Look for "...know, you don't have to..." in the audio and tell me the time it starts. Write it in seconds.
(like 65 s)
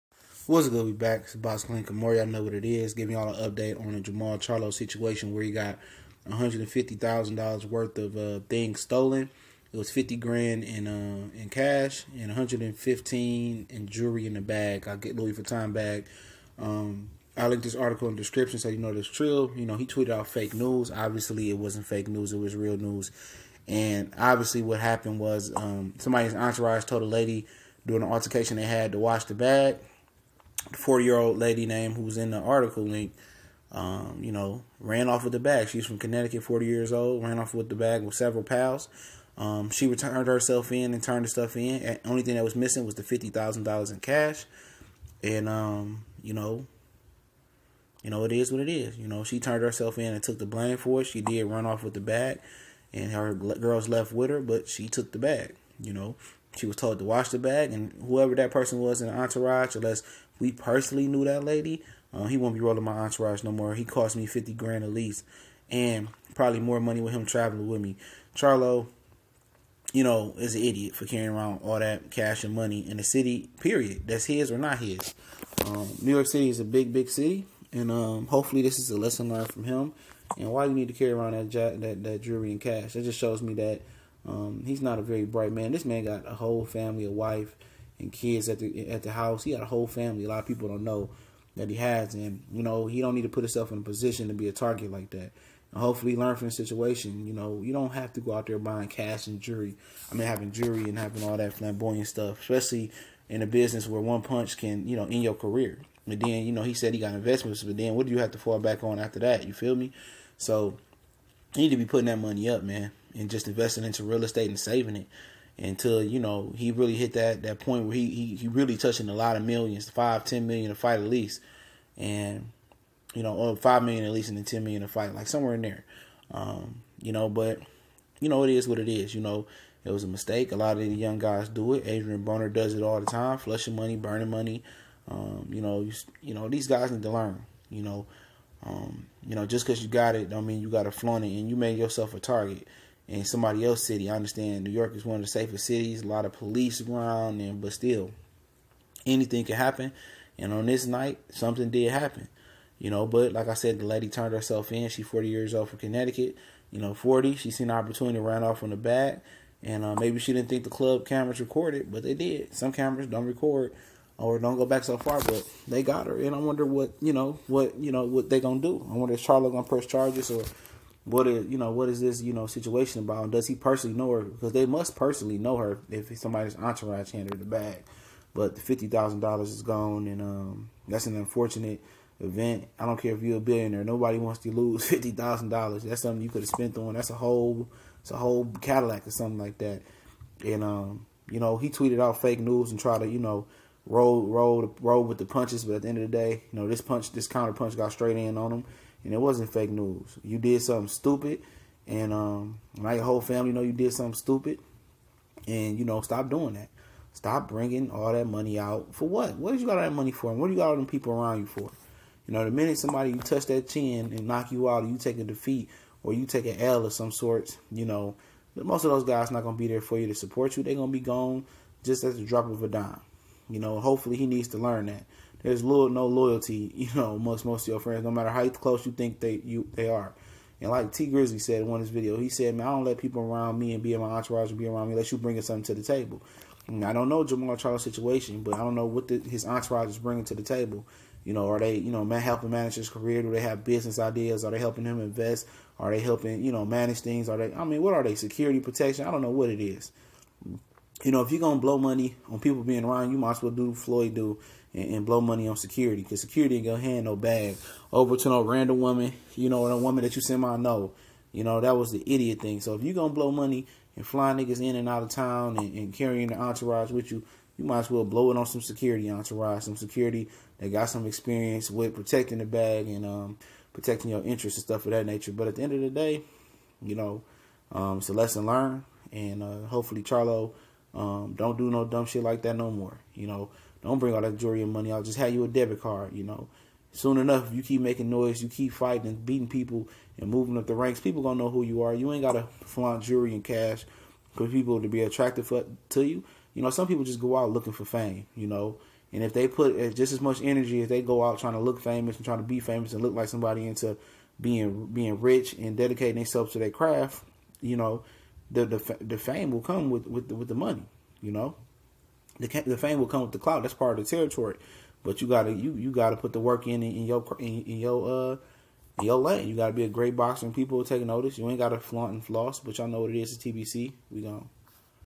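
97 s.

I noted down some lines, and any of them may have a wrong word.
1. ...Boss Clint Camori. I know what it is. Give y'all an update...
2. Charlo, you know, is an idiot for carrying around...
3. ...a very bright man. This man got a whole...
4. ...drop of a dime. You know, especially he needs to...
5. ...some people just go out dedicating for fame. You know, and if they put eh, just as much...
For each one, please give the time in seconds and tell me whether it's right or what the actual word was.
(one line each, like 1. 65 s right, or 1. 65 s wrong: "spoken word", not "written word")
1. 1 s right
2. 68 s right
3. 84 s right
4. 222 s wrong: "hopefully", not "especially"
5. 296 s wrong: "looking", not "dedicating".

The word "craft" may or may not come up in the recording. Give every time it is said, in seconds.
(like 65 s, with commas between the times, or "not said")
306 s.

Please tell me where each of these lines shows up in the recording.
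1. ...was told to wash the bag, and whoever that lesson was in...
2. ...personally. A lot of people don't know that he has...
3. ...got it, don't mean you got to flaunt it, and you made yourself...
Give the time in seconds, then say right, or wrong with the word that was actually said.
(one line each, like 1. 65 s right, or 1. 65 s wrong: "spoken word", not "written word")
1. 56 s wrong: "person", not "lesson"
2. 89 s wrong: "family", not "personally"
3. 139 s right.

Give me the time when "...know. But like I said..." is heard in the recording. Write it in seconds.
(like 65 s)
152 s.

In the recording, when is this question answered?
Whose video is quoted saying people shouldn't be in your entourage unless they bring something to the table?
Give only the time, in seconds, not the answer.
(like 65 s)
230 s.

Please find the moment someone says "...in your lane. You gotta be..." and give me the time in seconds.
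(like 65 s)
318 s.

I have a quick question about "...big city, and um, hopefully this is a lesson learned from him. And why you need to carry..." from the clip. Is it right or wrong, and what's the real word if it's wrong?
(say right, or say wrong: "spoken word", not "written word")
right.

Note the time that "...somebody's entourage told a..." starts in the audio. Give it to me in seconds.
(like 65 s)
25 s.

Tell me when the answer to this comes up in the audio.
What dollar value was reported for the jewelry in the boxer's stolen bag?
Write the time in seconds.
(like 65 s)
12 s.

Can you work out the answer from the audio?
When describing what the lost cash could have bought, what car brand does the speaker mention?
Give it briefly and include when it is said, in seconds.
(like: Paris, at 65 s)
Cadillac, at 188 s.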